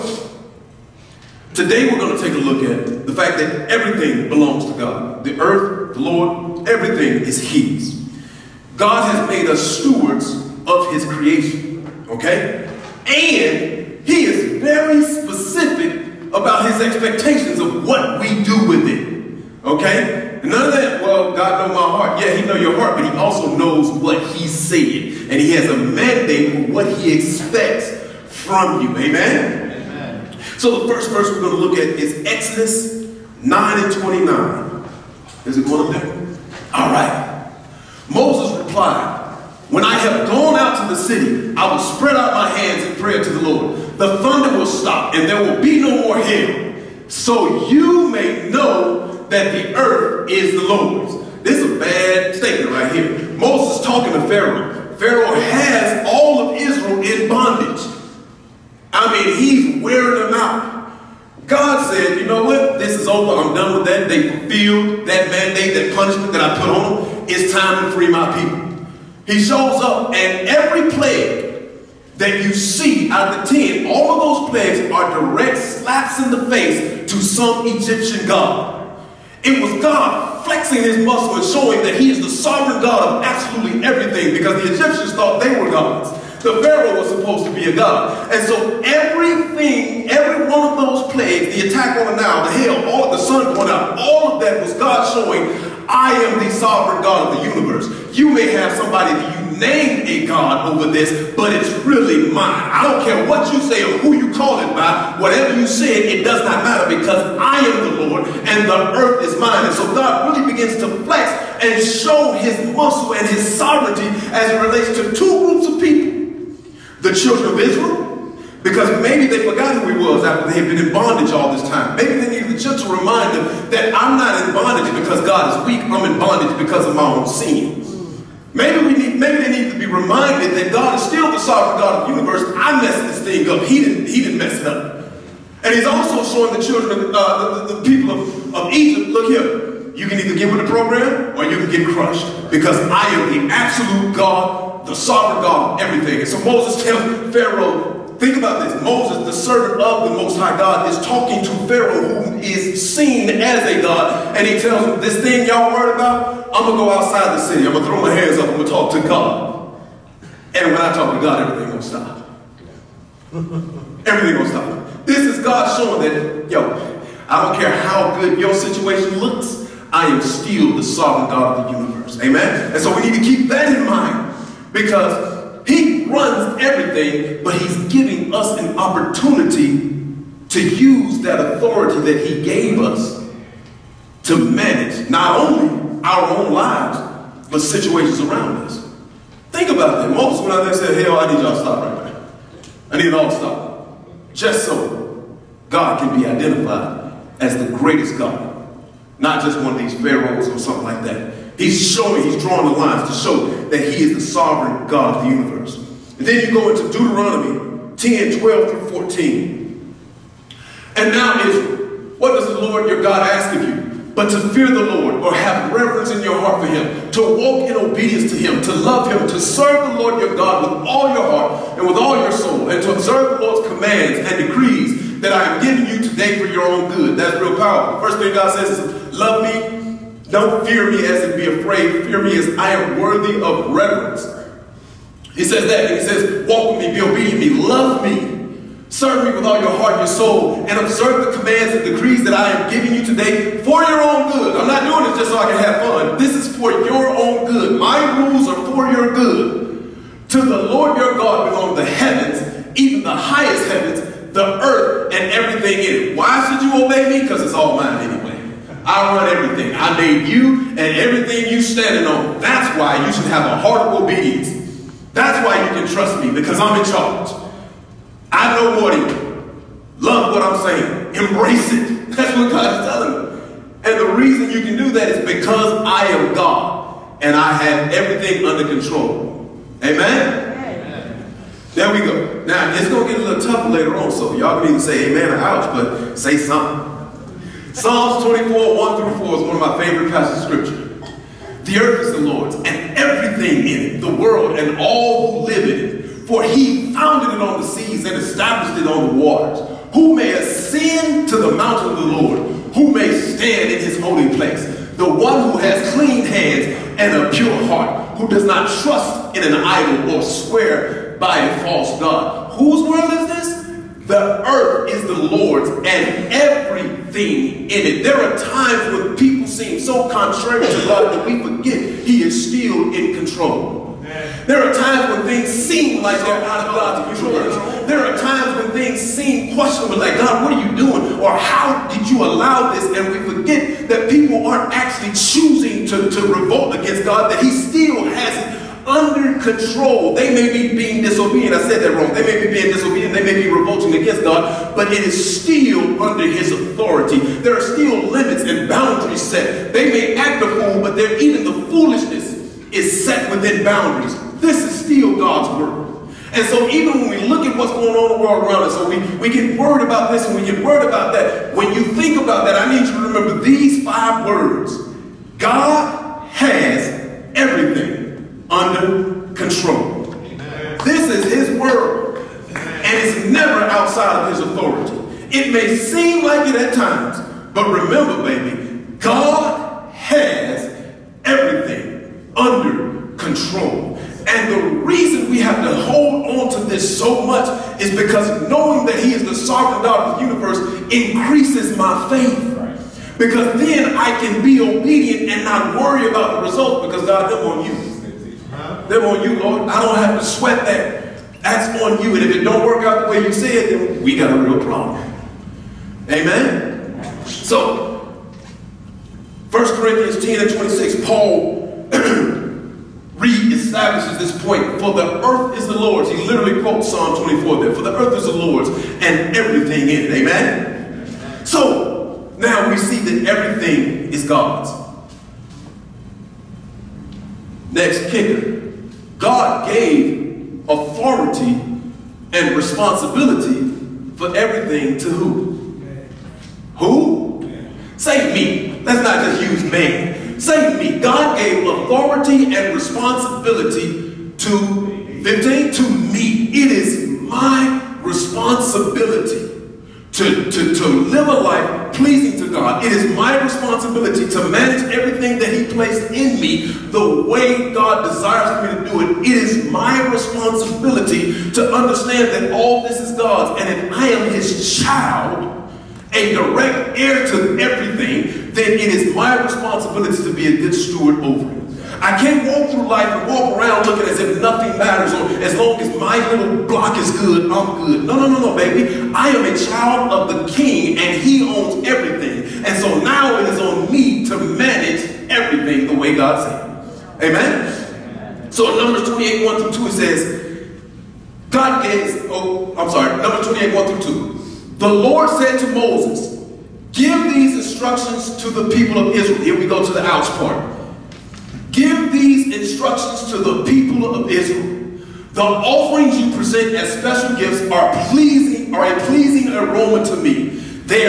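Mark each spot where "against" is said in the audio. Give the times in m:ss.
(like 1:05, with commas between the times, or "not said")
5:36, 5:43.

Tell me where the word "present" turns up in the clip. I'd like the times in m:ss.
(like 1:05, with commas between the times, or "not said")
8:26.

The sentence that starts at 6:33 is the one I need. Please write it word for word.
Because then I can be obedient and not worry about the results because God, them on you.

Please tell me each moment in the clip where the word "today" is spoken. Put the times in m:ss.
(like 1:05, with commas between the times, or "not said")
0:01, 3:46, 4:03.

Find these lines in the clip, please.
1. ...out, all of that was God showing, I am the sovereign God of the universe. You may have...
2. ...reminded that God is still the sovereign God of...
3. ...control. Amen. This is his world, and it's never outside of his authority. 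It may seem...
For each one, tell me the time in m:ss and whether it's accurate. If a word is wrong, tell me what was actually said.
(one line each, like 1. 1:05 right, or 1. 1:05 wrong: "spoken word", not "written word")
1. 1:33 right
2. 2:09 right
3. 6:09 right.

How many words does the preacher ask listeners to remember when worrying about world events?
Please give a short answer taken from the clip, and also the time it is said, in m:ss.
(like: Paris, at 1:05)
5, at 6:03.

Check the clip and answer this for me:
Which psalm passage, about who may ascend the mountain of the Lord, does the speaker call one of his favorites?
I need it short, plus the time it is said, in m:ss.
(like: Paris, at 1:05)
Psalms 24, at 4:47.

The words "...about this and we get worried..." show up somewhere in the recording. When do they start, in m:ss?
5:59.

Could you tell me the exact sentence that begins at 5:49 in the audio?
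They may act a fool, but even the foolishness is set within boundaries.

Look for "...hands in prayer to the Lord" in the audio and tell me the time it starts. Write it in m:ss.
0:42.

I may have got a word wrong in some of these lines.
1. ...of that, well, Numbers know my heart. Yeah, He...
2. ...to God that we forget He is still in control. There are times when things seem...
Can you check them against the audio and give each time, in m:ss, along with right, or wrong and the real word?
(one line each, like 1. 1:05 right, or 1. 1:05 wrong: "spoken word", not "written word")
1. 0:20 wrong: "God", not "Numbers"
2. 5:20 right.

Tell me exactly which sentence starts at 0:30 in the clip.
So the first verse we're going to look at is Exodus 9 and 29.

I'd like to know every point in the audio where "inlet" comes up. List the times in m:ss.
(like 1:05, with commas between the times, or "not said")
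not said.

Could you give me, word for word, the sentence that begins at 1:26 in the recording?
The Pharaoh was supposed to be a god.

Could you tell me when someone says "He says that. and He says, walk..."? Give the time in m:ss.
3:55.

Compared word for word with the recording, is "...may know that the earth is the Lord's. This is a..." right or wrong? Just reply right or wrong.
right.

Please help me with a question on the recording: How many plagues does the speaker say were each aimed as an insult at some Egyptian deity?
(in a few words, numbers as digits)
10.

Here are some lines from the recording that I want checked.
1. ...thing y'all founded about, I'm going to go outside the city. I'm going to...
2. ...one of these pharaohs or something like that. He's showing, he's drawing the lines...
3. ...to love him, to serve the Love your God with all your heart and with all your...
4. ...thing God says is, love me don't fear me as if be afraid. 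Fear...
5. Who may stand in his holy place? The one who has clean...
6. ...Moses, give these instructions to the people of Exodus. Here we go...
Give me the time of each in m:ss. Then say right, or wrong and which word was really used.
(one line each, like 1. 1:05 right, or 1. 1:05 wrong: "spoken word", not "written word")
1. 2:35 wrong: "worried", not "founded"
2. 3:19 right
3. 3:38 wrong: "Lord", not "Love"
4. 3:48 right
5. 5:02 right
6. 8:15 wrong: "Israel", not "Exodus".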